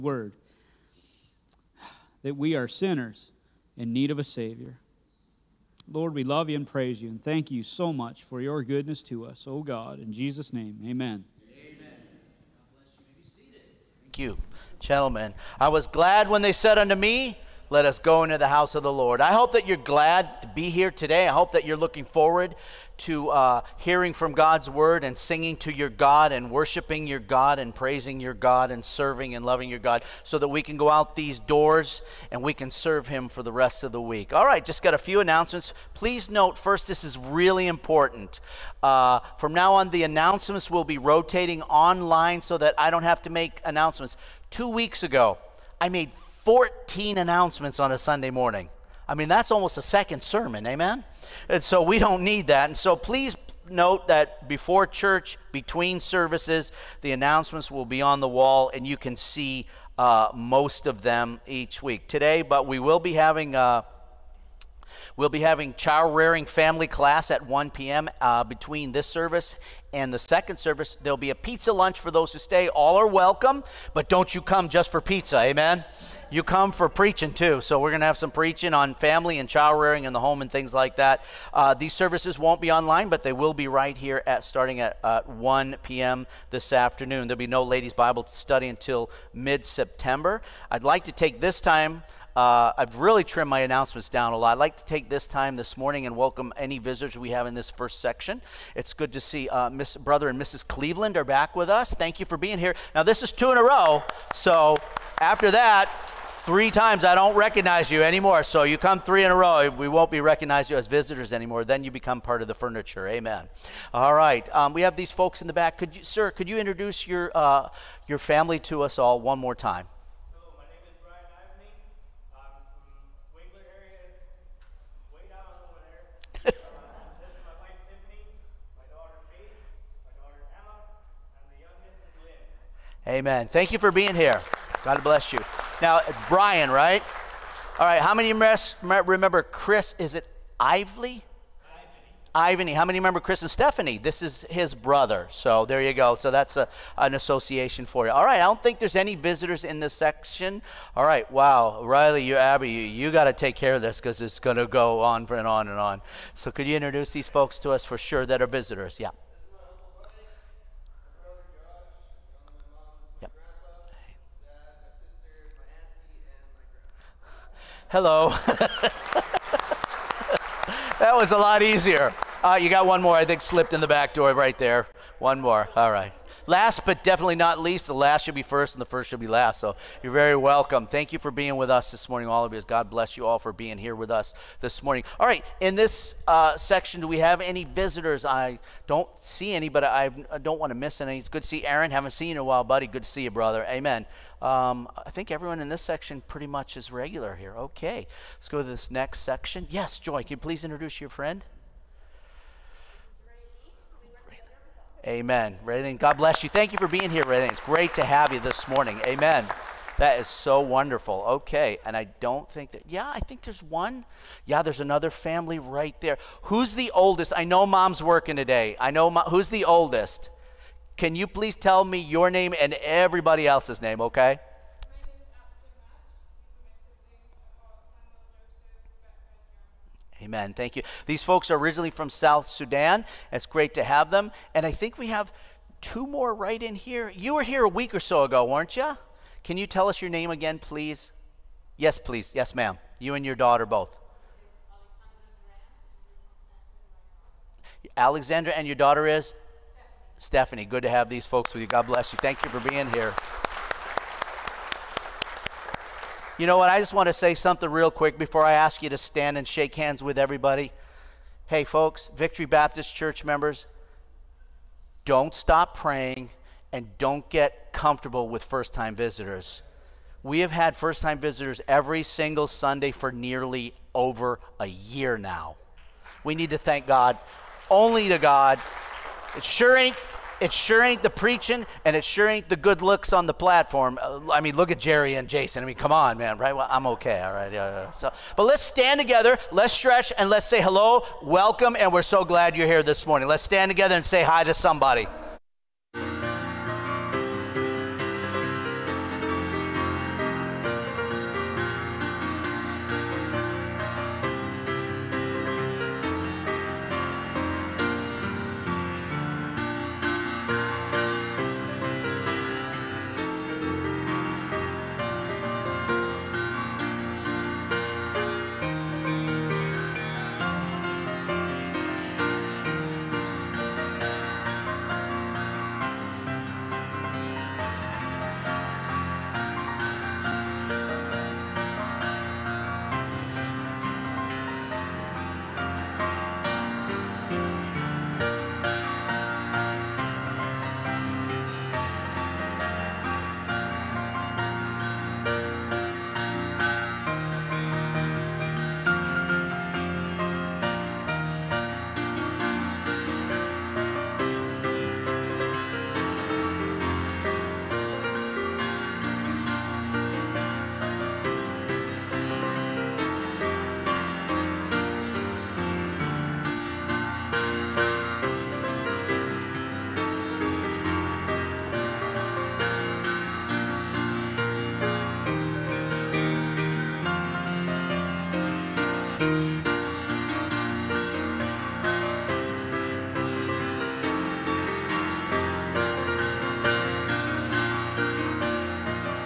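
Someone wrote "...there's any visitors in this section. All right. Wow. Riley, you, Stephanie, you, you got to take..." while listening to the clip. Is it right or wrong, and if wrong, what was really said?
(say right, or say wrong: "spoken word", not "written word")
wrong: "Abby", not "Stephanie".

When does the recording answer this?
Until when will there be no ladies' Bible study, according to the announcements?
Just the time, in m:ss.
1:29.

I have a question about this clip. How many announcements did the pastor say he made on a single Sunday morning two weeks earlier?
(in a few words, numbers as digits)
14.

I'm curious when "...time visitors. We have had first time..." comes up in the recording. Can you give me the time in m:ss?
4:28.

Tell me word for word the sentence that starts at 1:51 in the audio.
Then you become part of the furniture.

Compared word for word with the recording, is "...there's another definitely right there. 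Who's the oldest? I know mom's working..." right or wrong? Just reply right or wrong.
wrong.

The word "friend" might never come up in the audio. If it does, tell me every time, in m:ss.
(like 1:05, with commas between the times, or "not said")
3:21.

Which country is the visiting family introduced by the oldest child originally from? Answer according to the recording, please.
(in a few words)
South Sudan.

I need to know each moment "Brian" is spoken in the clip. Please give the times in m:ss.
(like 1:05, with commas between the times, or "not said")
2:16.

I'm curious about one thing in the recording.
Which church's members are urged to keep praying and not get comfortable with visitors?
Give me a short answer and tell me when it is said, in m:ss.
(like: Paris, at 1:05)
Victory Baptist Church, at 4:22.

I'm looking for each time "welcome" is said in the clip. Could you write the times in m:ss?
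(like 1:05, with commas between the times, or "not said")
1:13, 1:36, 3:00, 4:51.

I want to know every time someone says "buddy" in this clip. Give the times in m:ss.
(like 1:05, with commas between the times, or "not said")
3:12.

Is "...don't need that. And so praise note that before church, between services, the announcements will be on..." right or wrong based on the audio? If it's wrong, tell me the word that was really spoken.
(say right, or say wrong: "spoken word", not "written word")
wrong: "please", not "praise".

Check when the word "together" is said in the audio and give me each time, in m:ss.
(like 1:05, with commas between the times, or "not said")
4:48, 4:53.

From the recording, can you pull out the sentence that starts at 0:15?
I was glad when they said unto me, Let us go into the house of the Lord.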